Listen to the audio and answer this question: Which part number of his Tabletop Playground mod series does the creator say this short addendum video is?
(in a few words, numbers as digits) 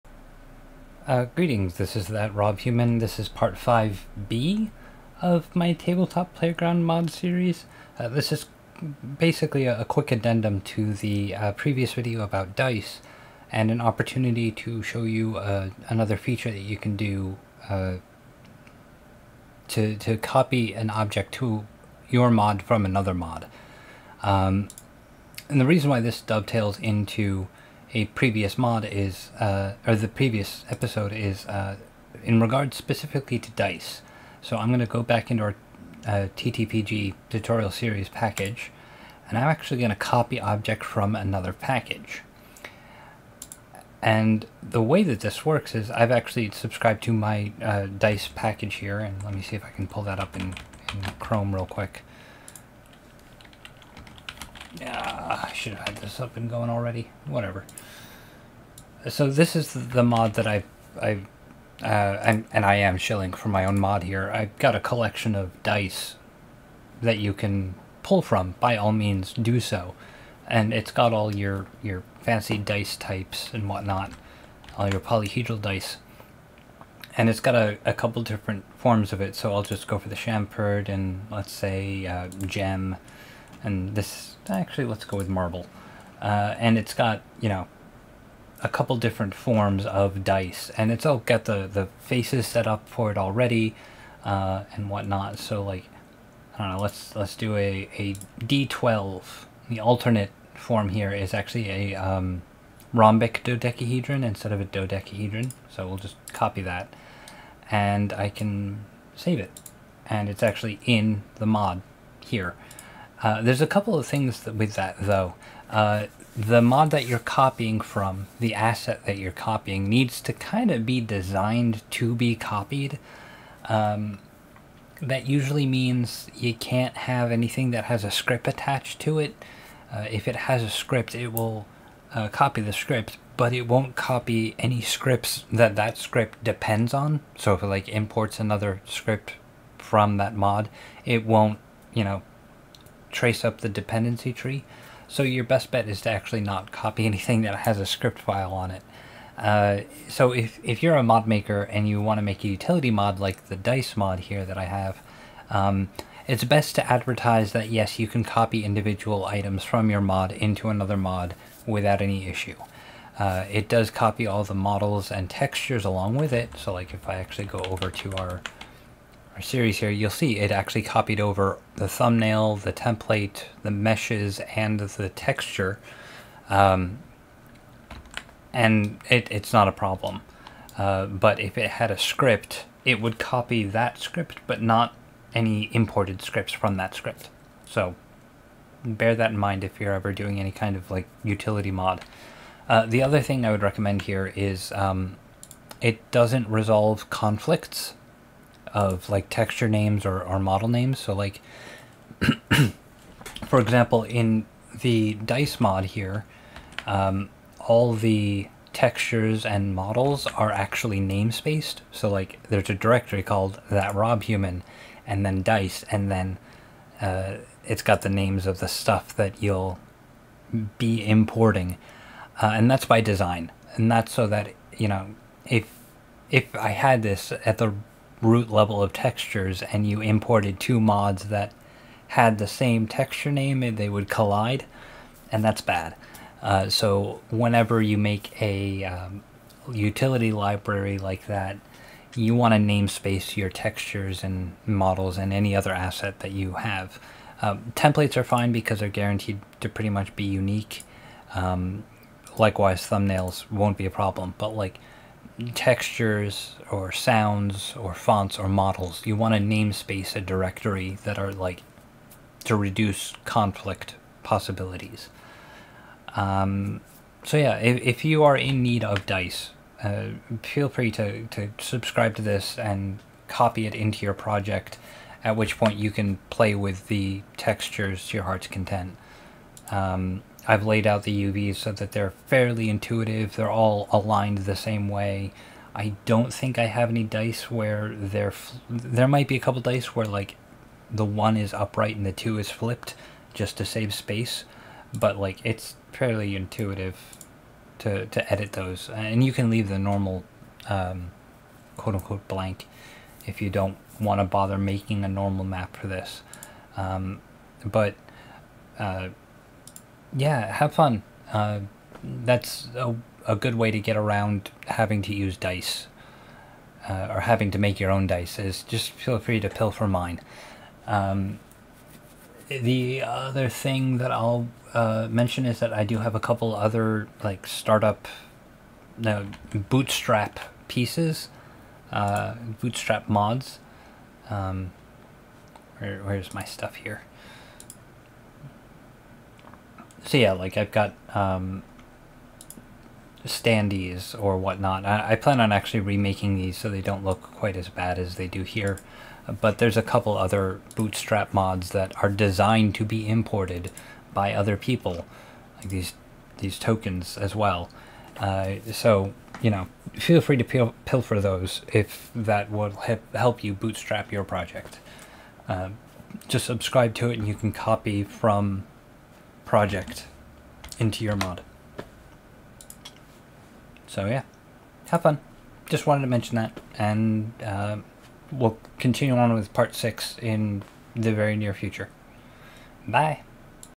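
5B.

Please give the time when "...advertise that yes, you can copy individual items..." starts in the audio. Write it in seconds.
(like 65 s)
156 s.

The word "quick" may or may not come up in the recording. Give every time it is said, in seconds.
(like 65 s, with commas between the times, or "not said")
9 s, 51 s.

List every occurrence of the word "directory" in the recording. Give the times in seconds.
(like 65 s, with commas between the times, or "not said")
212 s, 260 s.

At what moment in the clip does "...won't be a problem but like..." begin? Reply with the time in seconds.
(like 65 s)
253 s.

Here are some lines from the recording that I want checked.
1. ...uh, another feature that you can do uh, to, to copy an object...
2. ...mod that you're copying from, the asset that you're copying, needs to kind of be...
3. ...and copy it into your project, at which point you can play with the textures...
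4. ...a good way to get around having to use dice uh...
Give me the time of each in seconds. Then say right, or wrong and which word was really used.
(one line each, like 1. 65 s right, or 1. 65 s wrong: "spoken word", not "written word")
1. 15 s right
2. 116 s right
3. 272 s right
4. 313 s right.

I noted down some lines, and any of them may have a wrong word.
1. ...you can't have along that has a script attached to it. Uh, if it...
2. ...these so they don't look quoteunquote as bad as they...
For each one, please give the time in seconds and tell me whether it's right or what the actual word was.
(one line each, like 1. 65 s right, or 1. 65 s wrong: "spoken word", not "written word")
1. 126 s wrong: "anything", not "along"
2. 346 s wrong: "quite", not "quoteunquote".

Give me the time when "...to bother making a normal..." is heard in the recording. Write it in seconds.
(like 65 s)
304 s.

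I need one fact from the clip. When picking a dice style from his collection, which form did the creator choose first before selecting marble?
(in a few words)
chamfered.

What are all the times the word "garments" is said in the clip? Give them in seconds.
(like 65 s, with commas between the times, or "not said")
not said.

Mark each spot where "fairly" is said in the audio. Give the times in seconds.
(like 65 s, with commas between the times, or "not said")
282 s, 295 s.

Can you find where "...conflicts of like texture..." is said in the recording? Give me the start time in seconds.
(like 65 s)
197 s.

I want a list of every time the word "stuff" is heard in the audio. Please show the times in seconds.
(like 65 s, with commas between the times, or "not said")
218 s, 336 s.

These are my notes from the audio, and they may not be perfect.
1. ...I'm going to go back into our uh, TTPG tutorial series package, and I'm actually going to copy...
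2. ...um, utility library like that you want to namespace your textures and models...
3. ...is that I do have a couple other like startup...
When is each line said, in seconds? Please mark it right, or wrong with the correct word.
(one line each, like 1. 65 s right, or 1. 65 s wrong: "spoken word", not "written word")
1. 34 s right
2. 238 s right
3. 325 s right.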